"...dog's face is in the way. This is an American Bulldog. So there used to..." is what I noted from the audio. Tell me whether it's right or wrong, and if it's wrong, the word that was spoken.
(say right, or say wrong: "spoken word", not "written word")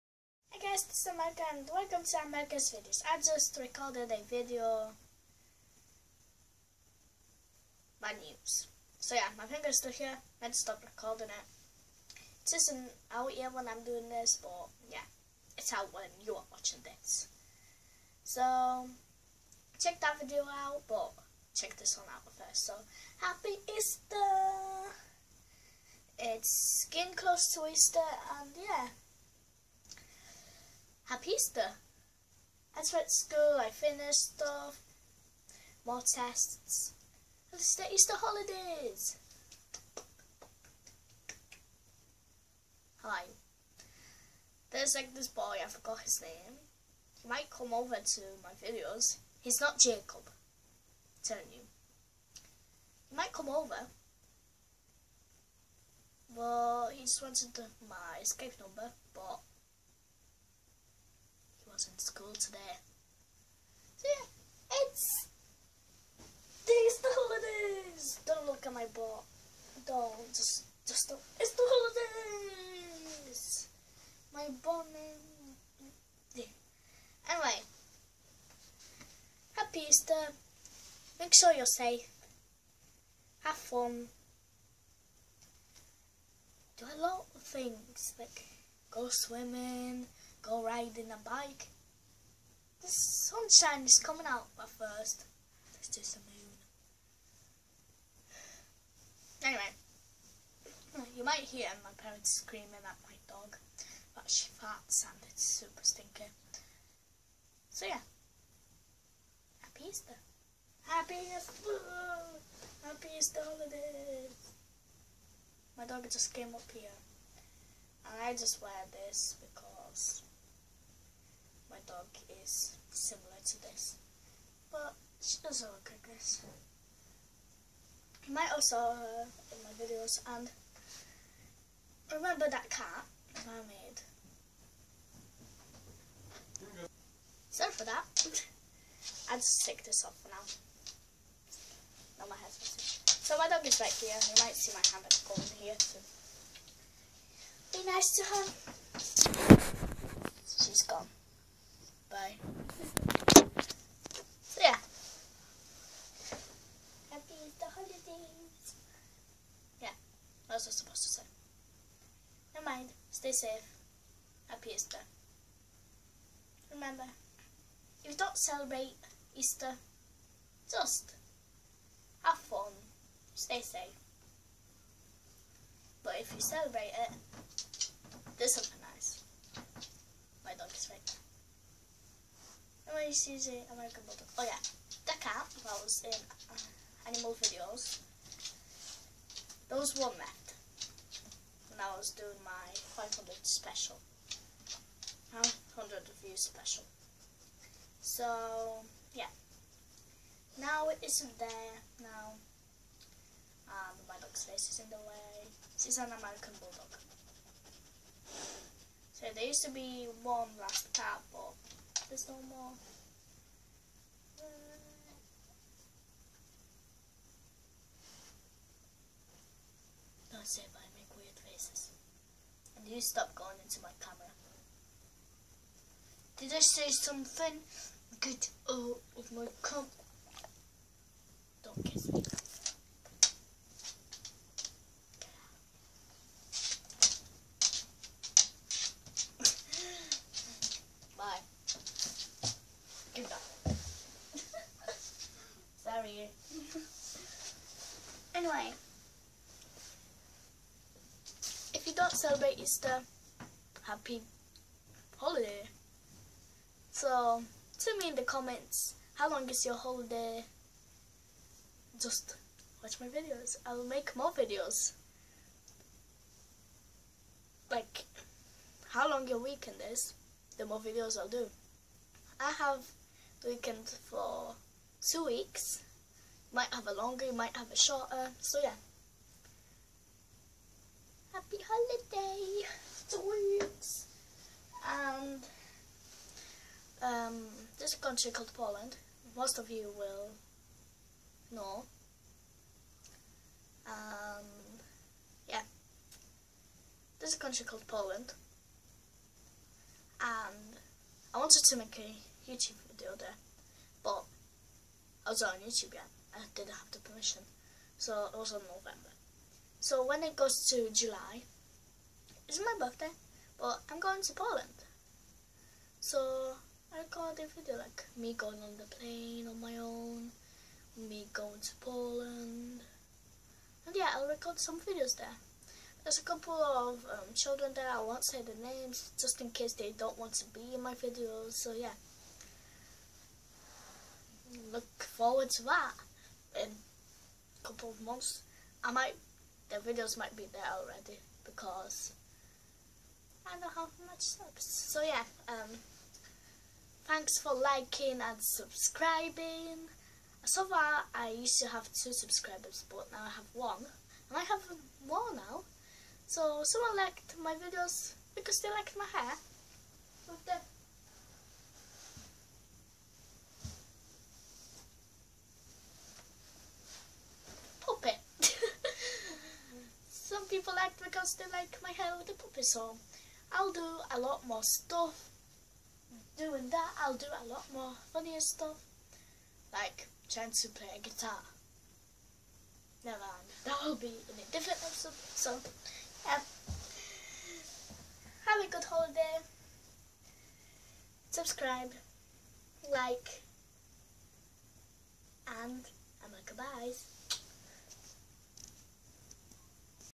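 right.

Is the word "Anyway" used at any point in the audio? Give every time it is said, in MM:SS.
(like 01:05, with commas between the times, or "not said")
01:17, 01:39.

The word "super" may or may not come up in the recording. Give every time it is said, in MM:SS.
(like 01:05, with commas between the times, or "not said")
01:45.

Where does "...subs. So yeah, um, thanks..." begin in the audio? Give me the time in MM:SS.
05:44.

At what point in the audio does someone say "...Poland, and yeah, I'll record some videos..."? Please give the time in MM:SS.
05:21.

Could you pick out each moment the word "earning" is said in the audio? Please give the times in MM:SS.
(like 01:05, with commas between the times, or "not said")
not said.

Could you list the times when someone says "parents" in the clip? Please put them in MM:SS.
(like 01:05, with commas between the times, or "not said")
01:41.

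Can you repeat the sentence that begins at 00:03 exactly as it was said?
I just recorded a video my news.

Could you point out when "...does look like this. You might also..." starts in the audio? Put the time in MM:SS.
02:05.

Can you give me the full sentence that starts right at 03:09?
There was one there when I was doing my 500 special.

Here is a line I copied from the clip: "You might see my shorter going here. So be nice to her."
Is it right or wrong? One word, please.
wrong.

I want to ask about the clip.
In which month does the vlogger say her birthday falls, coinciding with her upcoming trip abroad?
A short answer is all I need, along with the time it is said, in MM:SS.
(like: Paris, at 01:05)
July, at 05:10.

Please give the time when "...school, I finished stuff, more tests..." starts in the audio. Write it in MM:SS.
00:33.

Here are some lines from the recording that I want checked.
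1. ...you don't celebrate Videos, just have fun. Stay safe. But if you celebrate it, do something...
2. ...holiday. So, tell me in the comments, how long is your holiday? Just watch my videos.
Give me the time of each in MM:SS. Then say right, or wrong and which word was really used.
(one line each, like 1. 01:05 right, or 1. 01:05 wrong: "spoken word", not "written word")
1. 02:48 wrong: "Easter", not "Videos"
2. 04:15 right.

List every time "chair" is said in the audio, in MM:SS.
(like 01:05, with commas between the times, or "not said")
not said.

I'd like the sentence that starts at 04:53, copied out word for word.
Um, yeah, this country called Poland.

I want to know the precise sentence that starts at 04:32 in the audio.
I have the weekend for two weeks.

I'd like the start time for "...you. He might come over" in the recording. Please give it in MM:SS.
00:51.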